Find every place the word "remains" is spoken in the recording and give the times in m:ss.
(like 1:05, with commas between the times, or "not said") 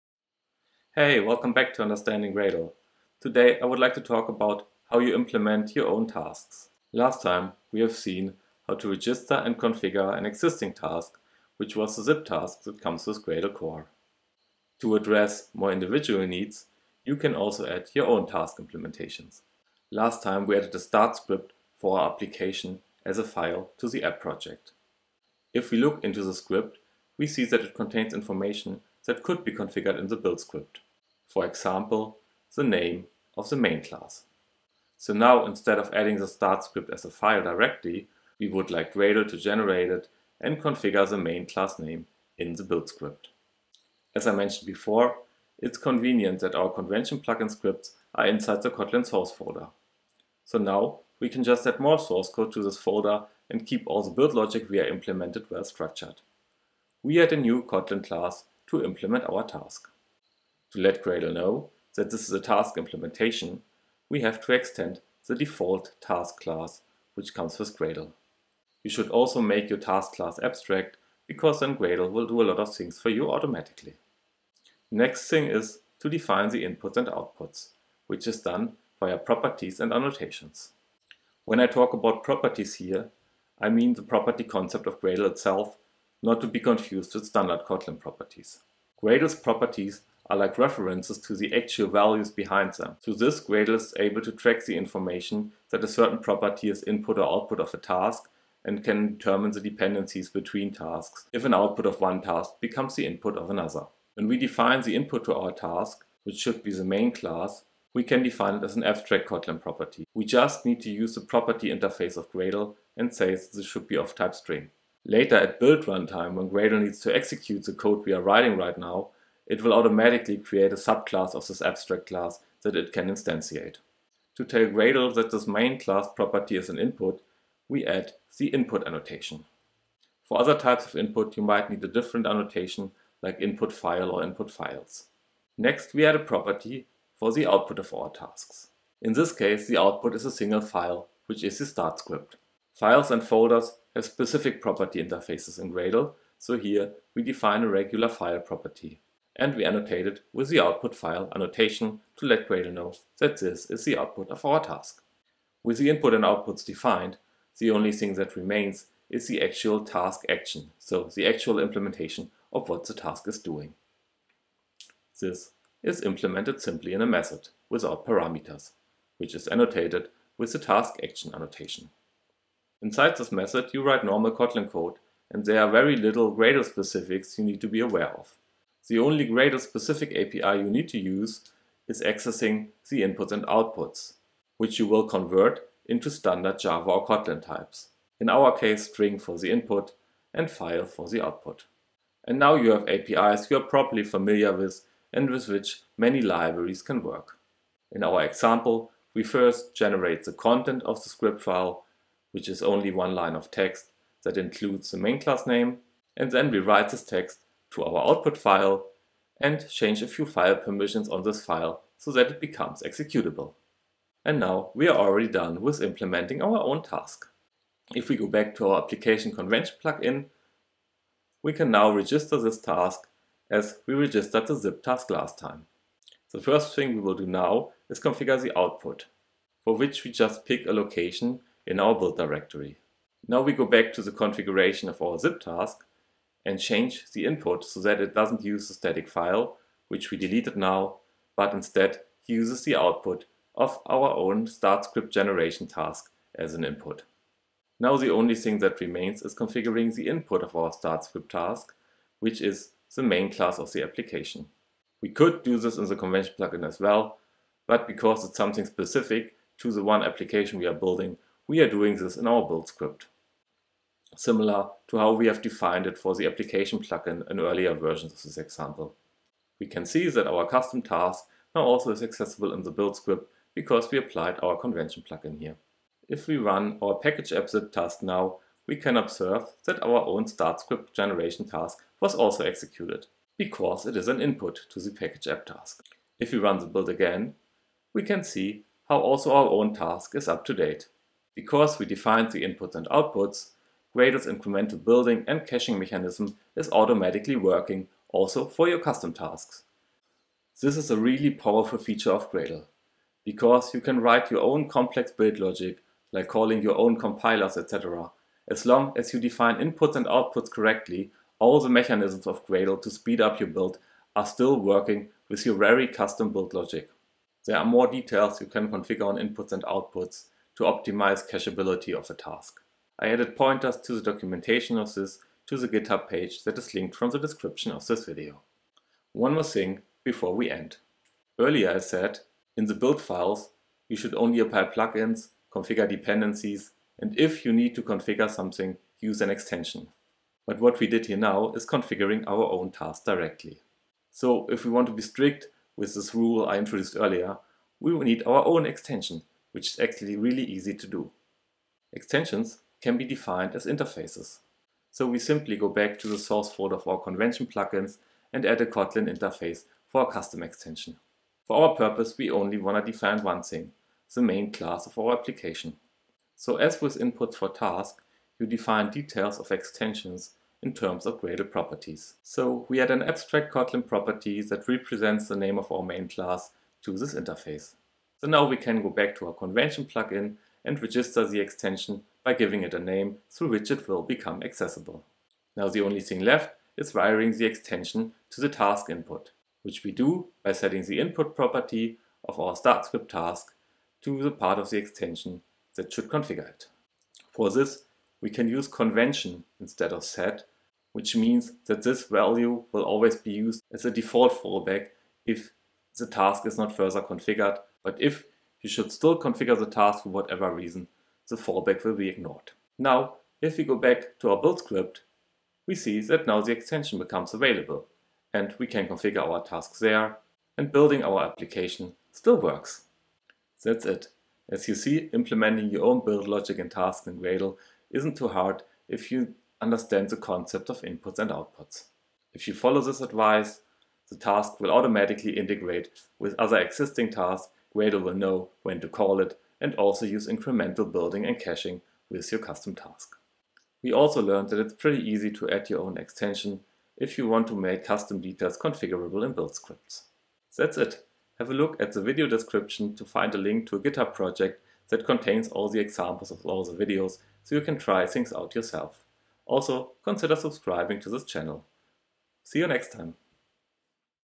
2:38, 4:08.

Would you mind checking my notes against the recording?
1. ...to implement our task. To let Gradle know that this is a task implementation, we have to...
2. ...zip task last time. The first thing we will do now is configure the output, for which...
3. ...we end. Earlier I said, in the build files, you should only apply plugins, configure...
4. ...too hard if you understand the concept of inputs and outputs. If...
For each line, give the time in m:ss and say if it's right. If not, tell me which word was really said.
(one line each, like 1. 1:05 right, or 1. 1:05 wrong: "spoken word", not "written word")
1. 0:58 right
2. 3:44 right
3. 5:30 right
4. 7:08 right.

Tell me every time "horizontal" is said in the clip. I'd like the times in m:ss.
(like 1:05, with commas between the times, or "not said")
not said.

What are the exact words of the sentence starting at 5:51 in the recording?
Extensions can be defined as interfaces.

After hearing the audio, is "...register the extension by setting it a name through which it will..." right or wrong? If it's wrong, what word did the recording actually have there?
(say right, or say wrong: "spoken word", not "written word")
wrong: "giving", not "setting".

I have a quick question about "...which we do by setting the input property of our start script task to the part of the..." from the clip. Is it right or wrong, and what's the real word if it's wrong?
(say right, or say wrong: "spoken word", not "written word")
right.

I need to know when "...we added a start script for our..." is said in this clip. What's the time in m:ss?
0:20.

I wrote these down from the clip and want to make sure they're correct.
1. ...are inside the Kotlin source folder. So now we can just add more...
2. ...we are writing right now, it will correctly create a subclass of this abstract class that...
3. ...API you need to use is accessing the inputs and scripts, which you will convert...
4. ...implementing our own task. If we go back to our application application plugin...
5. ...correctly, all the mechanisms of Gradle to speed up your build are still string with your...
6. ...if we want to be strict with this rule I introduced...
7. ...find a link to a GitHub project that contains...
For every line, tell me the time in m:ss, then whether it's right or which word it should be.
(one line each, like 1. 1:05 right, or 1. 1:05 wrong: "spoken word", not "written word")
1. 0:48 right
2. 1:58 wrong: "automatically", not "correctly"
3. 3:00 wrong: "outputs", not "scripts"
4. 3:35 wrong: "convention", not "application"
5. 5:10 wrong: "working", not "string"
6. 5:44 right
7. 7:33 right.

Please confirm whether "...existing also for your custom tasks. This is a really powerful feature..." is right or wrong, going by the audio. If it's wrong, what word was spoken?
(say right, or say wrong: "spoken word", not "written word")
wrong: "working", not "existing".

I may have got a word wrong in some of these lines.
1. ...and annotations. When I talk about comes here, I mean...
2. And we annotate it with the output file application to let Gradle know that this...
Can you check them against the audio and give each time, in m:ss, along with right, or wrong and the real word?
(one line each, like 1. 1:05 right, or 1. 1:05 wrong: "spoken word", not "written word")
1. 1:19 wrong: "properties", not "comes"
2. 2:29 wrong: "annotation", not "application".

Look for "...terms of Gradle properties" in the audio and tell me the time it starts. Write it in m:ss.
6:10.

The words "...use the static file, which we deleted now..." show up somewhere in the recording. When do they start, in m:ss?
3:58.